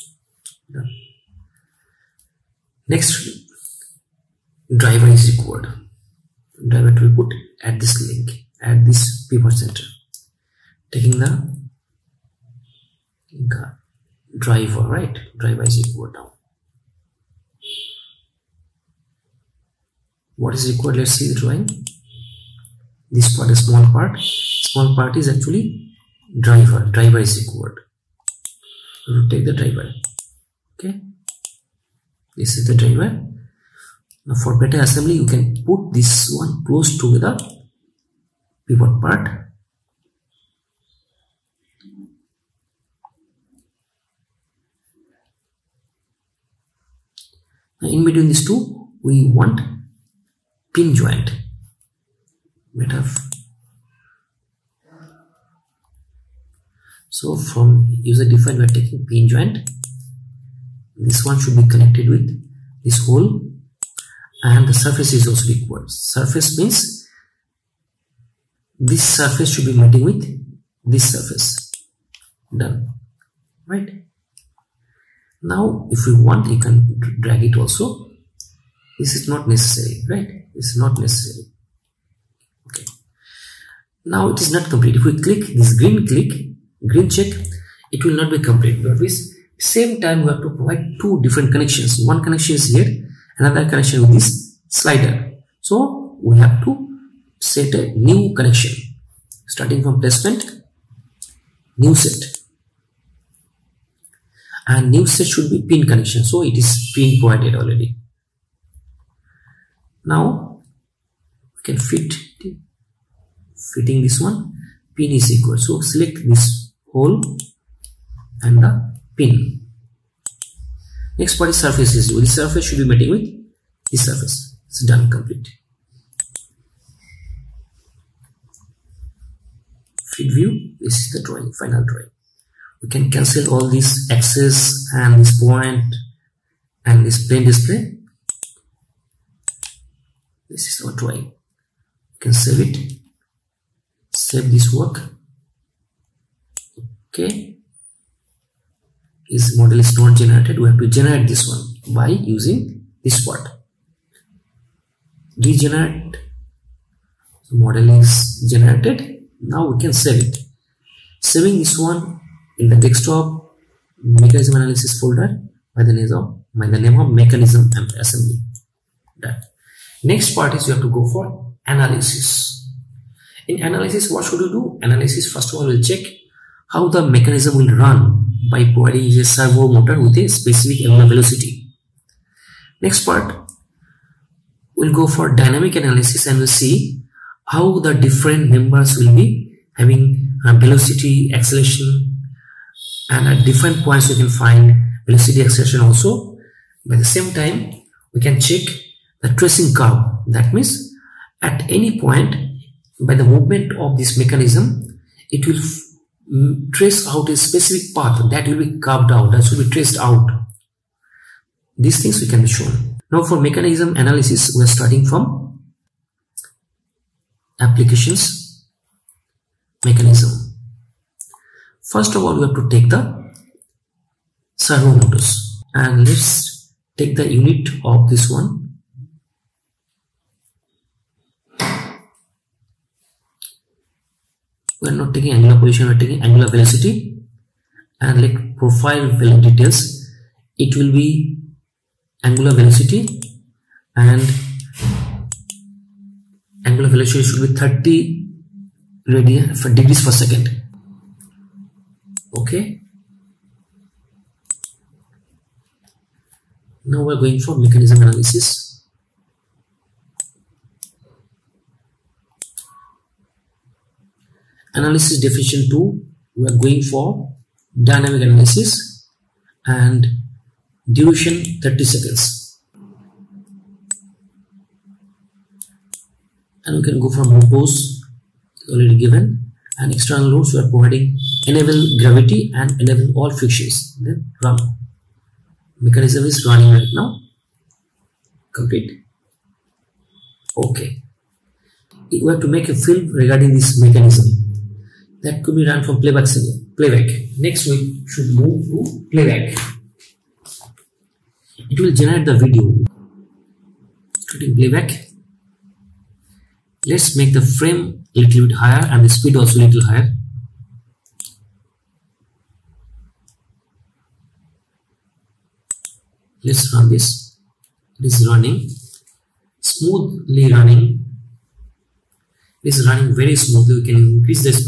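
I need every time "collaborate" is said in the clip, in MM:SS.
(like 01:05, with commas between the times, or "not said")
not said.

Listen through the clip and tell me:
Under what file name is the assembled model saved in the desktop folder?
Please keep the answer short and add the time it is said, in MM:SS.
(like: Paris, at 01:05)
Mechanism assembly, at 02:47.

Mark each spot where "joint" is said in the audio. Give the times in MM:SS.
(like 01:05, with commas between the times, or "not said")
00:50, 00:59.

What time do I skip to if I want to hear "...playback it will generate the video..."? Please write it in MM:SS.
04:59.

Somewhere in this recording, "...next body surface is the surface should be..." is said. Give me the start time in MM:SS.
02:01.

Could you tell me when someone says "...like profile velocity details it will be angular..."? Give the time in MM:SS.
03:58.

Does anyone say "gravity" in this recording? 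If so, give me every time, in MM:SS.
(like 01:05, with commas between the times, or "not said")
04:42.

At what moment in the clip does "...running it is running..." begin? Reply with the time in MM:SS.
05:20.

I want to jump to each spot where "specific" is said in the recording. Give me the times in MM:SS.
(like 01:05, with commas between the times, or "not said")
03:00, 03:27.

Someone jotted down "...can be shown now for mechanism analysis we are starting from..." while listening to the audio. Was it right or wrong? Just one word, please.
right.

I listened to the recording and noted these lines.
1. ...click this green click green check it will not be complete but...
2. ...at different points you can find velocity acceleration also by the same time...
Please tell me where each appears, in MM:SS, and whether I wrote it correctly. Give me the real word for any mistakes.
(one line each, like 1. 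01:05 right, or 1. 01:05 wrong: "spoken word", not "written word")
1. 01:25 right
2. 03:13 right.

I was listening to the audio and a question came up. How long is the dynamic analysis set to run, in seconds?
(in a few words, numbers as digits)
30 seconds.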